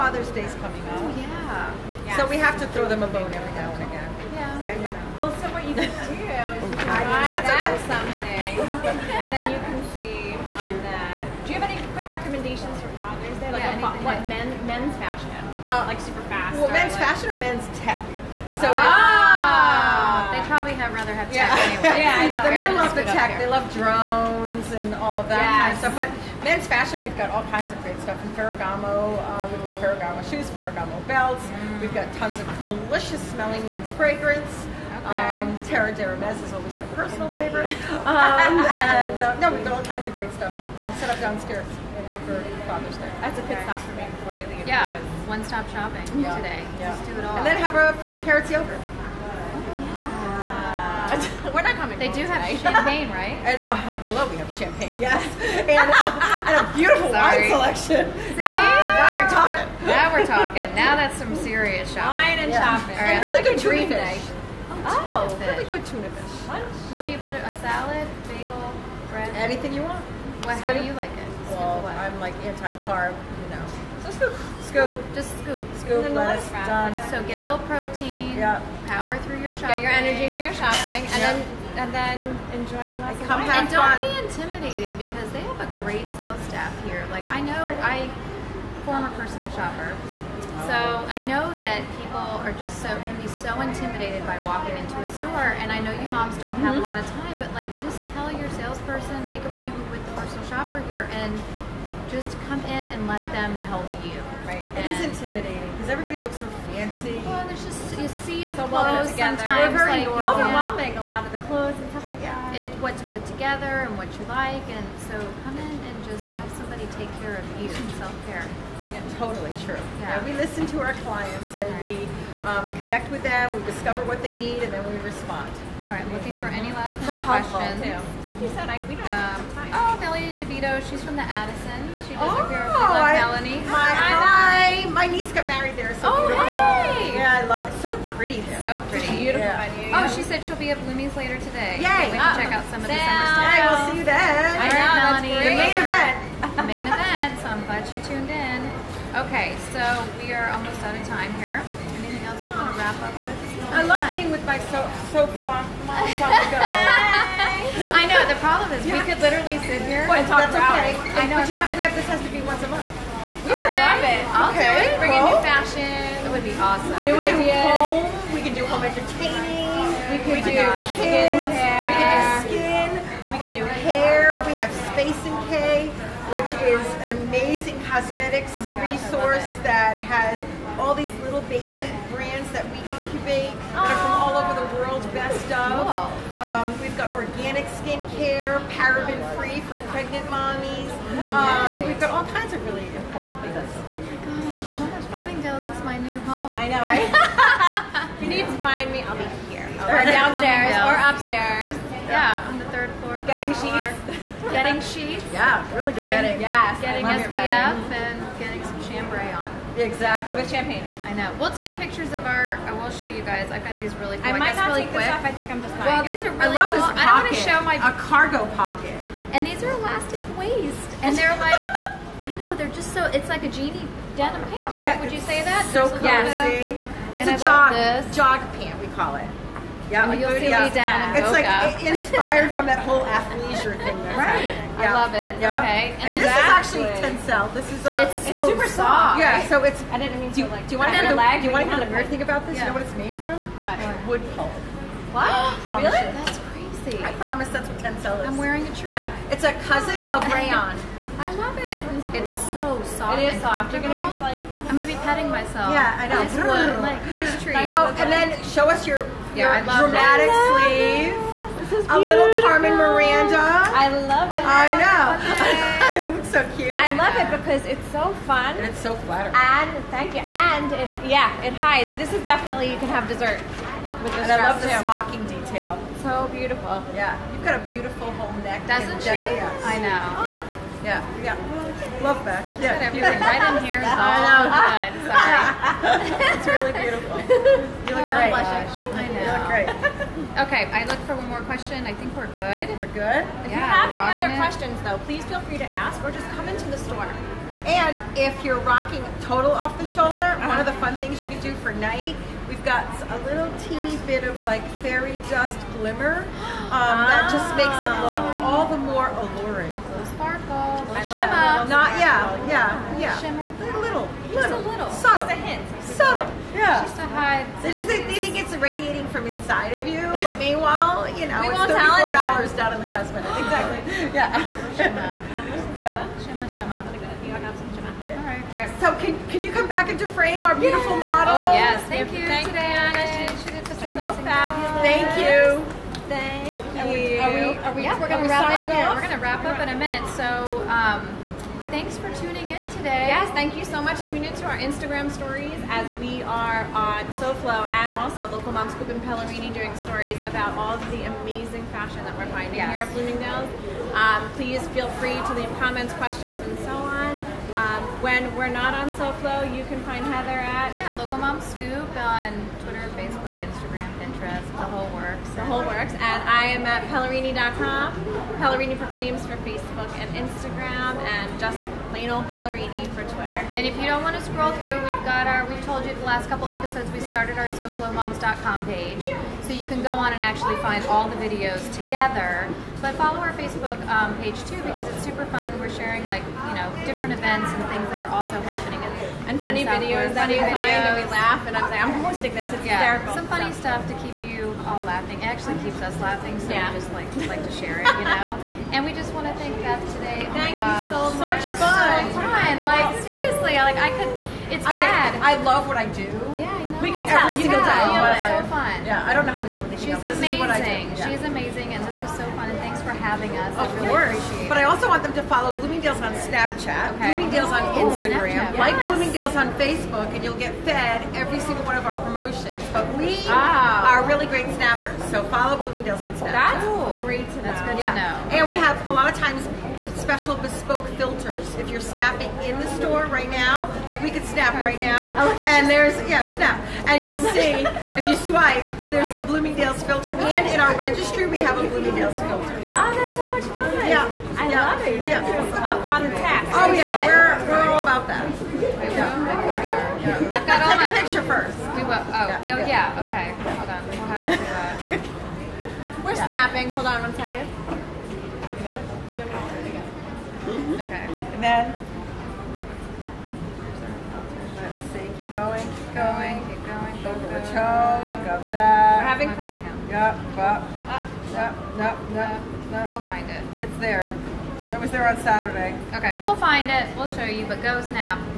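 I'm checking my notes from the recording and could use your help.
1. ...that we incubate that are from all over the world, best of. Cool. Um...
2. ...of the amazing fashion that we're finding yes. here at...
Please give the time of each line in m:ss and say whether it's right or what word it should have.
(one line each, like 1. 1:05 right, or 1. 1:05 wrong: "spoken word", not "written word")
1. 3:02 right
2. 5:50 right.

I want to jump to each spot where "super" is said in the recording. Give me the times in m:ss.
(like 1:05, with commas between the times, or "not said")
0:16, 3:58, 6:25.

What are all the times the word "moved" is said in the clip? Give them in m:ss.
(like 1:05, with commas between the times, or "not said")
not said.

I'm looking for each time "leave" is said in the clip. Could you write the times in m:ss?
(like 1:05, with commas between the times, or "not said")
0:44, 5:55.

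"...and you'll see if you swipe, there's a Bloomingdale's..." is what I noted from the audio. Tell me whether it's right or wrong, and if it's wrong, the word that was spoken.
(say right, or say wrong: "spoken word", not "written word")
right.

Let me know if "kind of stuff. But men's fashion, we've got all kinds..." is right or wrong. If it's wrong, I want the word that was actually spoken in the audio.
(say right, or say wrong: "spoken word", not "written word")
right.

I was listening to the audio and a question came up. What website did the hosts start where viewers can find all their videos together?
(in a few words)
SoFloMoms.com.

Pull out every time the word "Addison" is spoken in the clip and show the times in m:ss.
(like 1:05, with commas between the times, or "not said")
2:11.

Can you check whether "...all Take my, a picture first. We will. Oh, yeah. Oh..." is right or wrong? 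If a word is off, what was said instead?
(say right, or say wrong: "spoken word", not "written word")
right.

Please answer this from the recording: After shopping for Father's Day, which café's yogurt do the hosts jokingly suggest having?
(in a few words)
40 Carrots.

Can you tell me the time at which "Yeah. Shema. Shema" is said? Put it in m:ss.
5:24.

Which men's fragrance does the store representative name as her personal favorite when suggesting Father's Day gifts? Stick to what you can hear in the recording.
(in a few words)
Terre d'Hermès.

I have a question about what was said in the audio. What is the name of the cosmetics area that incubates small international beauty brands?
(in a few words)
Space in K.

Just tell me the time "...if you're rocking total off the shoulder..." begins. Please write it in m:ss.
4:58.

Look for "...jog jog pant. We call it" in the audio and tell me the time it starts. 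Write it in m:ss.
3:47.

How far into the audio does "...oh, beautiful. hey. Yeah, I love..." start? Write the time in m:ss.
2:16.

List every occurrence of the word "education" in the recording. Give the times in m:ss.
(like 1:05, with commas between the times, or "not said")
not said.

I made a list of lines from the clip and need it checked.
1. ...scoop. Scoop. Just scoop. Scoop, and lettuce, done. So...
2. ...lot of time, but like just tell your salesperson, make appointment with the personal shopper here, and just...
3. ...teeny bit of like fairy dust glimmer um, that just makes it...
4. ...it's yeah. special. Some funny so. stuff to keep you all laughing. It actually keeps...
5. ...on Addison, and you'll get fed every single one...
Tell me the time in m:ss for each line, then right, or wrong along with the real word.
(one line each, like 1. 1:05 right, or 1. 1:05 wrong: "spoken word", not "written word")
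1. 1:14 right
2. 1:36 right
3. 5:03 right
4. 6:32 wrong: "hysterical", not "special"
5. 6:59 wrong: "Facebook", not "Addison".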